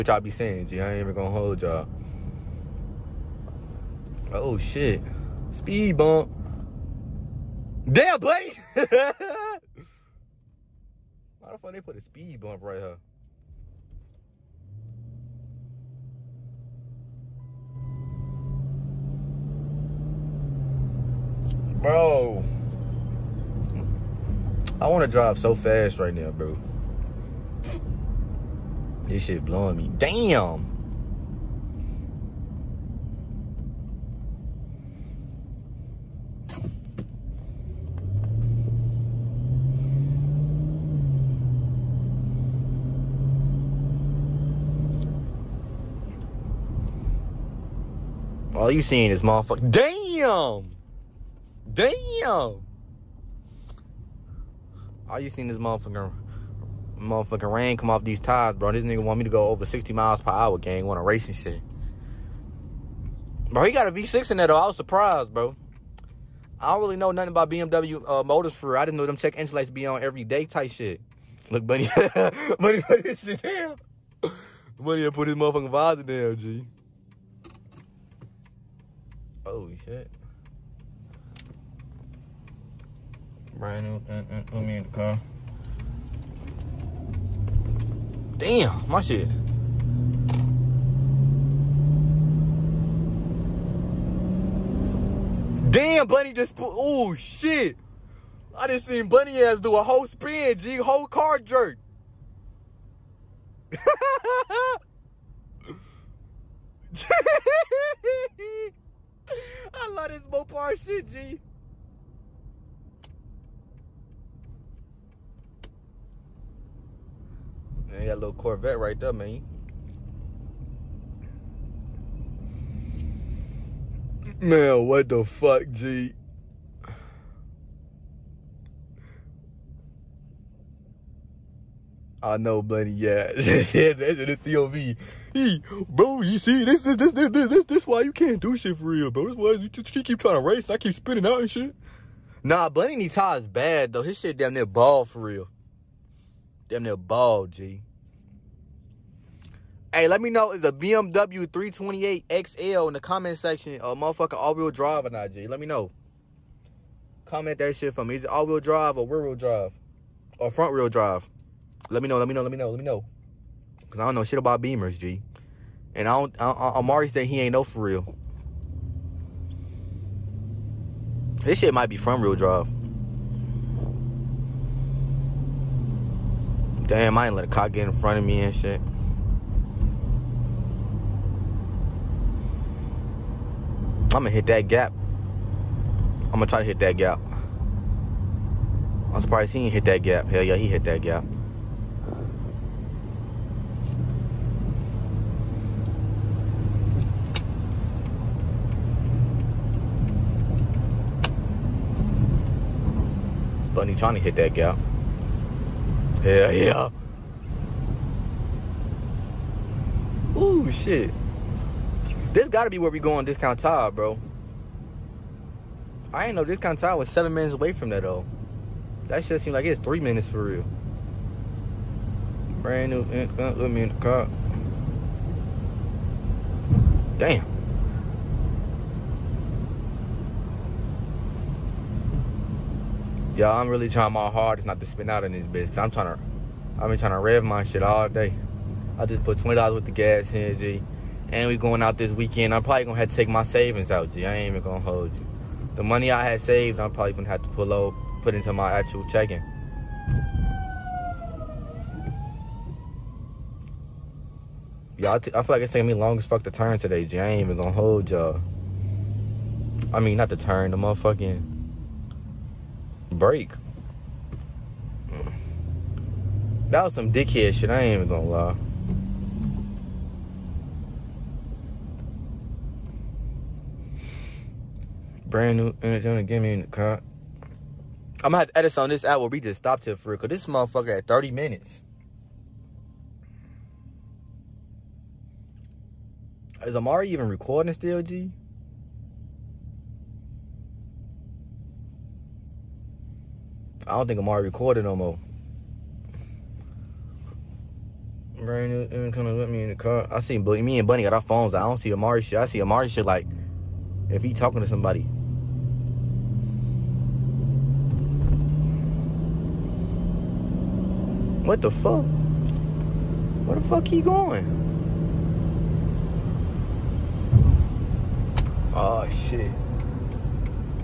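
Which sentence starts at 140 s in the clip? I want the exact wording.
I keep spinning out and shit.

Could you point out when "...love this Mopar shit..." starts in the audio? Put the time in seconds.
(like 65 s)
109 s.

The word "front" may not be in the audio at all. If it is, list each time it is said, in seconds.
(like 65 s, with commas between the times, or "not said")
160 s, 171 s, 177 s.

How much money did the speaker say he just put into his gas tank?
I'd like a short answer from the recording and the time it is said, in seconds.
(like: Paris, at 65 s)
$20, at 239 s.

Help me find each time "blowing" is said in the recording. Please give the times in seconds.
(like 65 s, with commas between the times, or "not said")
29 s.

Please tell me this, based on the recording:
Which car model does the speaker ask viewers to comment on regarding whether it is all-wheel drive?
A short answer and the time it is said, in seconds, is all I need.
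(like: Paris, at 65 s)
BMW 328XL, at 150 s.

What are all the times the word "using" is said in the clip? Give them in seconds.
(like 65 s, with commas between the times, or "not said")
not said.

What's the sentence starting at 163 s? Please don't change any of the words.
Because I don't know shit about Beamers, G.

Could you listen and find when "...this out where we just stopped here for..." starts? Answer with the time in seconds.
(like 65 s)
278 s.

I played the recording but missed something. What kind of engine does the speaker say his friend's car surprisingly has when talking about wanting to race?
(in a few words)
V6.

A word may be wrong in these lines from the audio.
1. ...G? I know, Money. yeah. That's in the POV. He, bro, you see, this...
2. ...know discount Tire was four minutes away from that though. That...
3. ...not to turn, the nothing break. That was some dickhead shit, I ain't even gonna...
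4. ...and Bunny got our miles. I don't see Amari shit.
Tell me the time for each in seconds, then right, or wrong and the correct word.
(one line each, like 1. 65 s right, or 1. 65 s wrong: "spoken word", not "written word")
1. 125 s wrong: "Blenny", not "Money"
2. 216 s wrong: "seven", not "four"
3. 260 s wrong: "motherfucking", not "nothing"
4. 300 s wrong: "phones", not "miles".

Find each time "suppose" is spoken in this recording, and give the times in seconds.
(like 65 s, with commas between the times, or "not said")
not said.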